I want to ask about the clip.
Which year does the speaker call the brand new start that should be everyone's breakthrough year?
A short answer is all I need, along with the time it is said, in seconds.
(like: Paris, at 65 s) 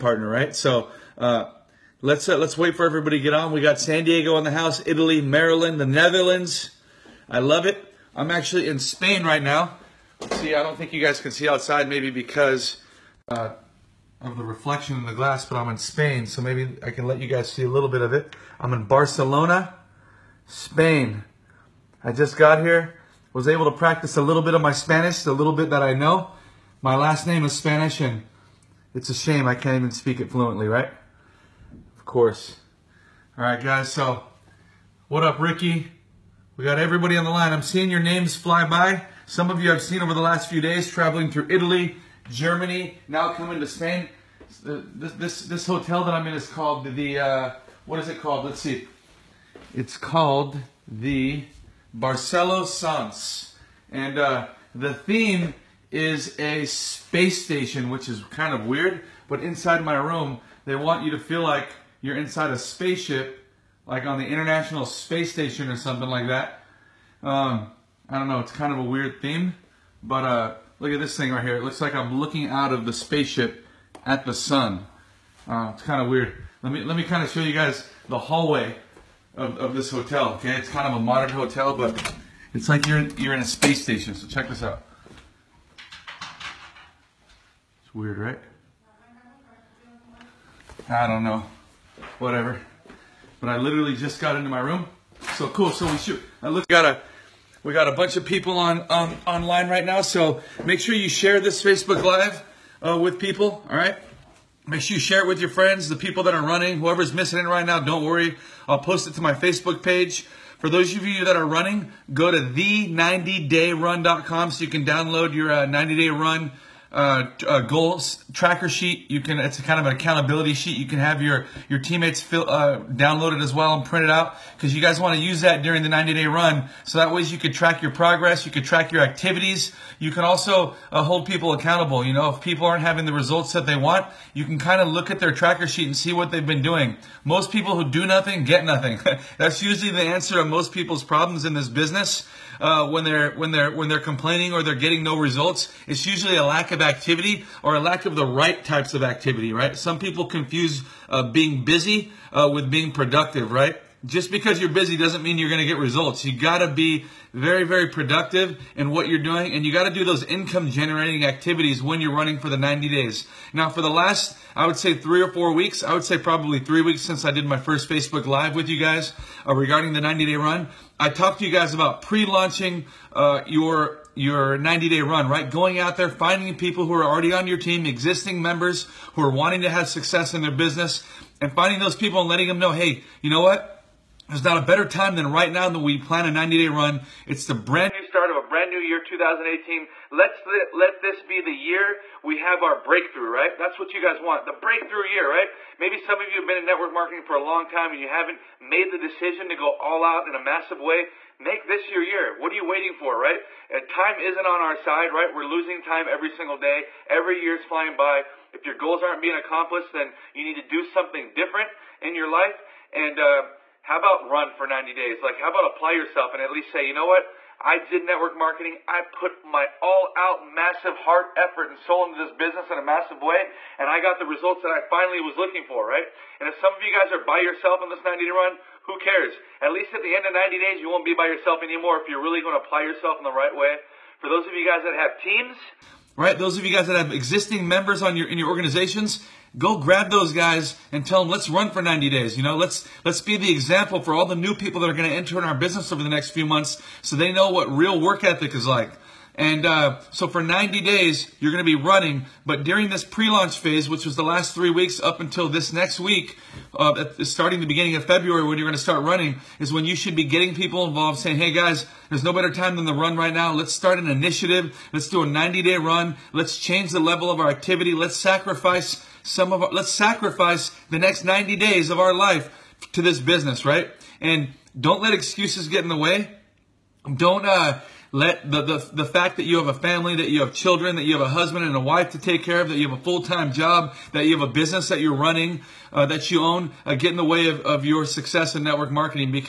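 2018, at 188 s.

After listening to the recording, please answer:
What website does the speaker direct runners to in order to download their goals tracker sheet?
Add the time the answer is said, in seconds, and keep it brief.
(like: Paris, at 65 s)
the90dayrun.com, at 112 s.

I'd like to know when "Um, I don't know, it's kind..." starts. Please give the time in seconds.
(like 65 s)
67 s.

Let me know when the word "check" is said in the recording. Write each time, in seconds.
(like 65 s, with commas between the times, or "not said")
84 s.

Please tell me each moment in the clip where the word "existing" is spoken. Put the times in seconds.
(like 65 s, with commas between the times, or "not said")
177 s, 237 s.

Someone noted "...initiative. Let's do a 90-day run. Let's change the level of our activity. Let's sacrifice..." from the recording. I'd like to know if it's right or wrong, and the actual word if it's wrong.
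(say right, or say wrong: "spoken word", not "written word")
right.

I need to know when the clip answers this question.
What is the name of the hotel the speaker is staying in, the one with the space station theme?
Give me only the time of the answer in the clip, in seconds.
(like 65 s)
51 s.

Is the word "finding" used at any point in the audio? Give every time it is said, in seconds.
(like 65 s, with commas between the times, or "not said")
176 s, 181 s.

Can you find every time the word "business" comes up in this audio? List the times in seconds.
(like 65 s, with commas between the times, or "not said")
141 s, 180 s, 222 s, 245 s, 273 s, 284 s.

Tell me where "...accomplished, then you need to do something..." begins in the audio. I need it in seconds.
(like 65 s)
209 s.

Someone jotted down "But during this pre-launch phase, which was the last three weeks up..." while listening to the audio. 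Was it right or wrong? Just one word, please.
right.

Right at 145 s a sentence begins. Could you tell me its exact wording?
It's usually a lack of activity or a lack of the right types of activity, right?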